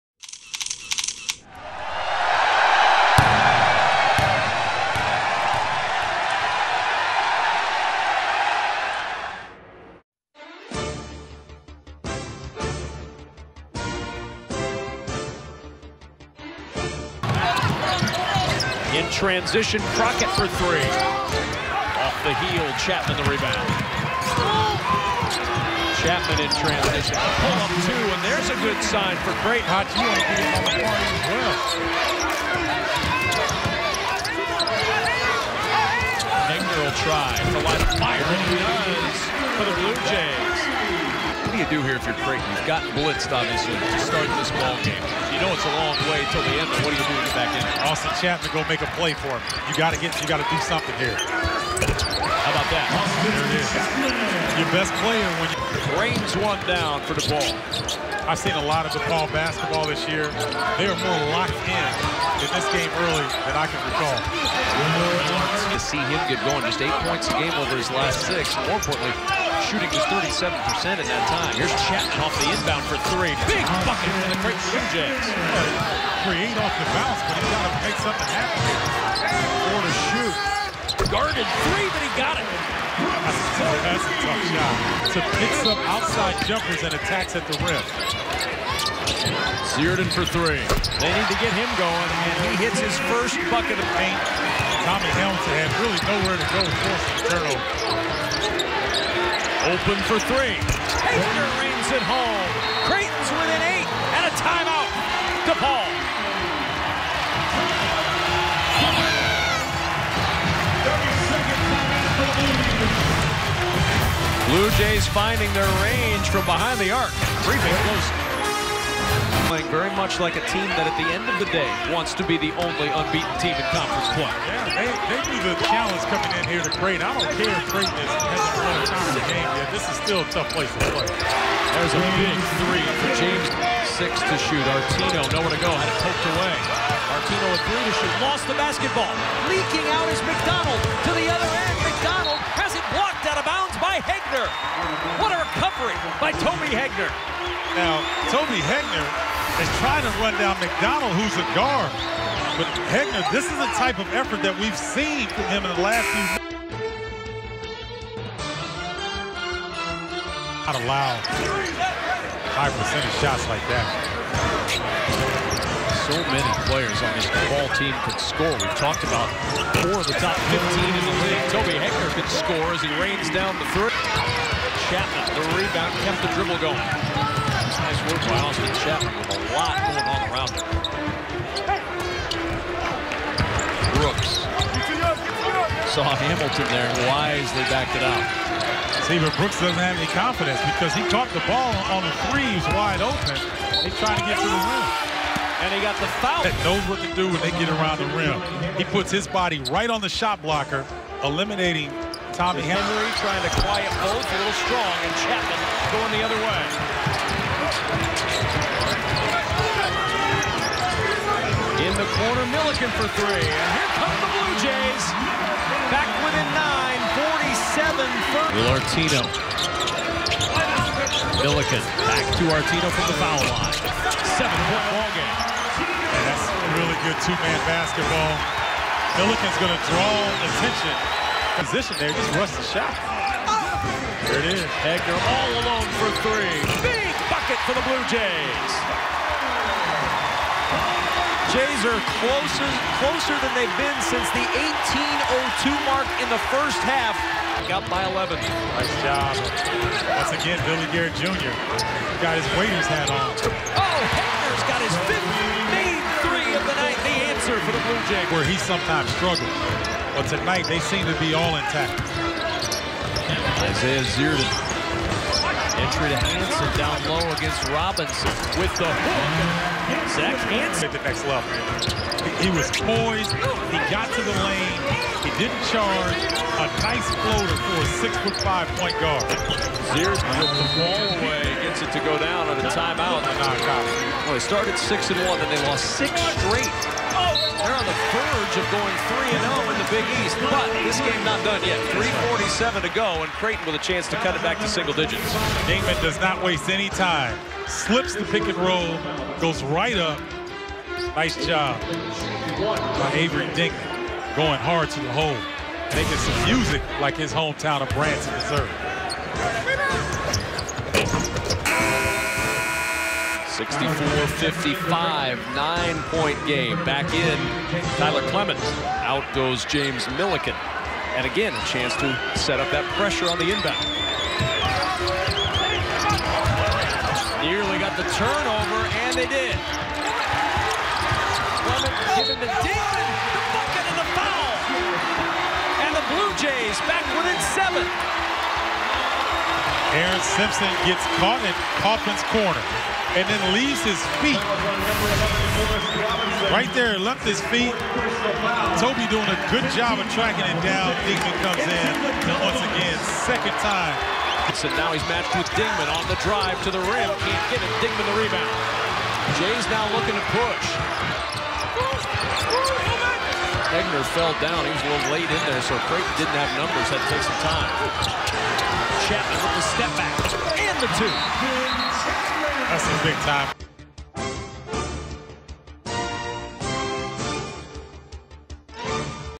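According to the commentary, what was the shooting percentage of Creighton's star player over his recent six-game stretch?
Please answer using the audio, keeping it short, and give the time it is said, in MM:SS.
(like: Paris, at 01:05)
37%, at 01:10.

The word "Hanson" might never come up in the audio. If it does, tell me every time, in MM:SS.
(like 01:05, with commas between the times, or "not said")
04:26, 04:30.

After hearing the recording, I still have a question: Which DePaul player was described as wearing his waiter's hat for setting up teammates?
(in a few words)
Billy Garrett Jr.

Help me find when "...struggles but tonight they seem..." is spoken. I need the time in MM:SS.
04:19.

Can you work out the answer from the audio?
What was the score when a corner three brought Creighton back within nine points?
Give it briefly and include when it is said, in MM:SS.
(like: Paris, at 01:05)
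47-30, at 03:37.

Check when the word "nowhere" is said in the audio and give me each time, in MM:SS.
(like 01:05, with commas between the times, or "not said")
01:36, 02:15.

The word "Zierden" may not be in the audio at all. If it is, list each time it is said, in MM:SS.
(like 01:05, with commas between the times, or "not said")
01:29, 04:24, 04:39.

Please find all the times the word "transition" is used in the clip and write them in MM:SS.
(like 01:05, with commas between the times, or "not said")
00:19, 00:26.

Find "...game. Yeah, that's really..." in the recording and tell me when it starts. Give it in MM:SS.
03:45.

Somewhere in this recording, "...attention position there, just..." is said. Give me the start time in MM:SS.
03:50.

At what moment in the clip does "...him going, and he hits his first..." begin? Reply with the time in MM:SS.
01:31.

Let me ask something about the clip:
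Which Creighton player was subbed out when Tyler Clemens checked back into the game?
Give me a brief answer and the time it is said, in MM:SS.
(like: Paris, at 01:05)
James Milliken, at 05:19.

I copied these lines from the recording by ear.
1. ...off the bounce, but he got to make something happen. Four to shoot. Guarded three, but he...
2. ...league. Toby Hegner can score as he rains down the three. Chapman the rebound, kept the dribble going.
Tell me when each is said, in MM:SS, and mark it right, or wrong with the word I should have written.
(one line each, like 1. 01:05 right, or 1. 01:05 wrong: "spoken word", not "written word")
1. 01:16 right
2. 02:51 right.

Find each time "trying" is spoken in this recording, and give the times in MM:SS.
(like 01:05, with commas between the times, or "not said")
02:29, 03:13, 03:23.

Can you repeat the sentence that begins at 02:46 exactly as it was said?
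So many players on this ball team can score.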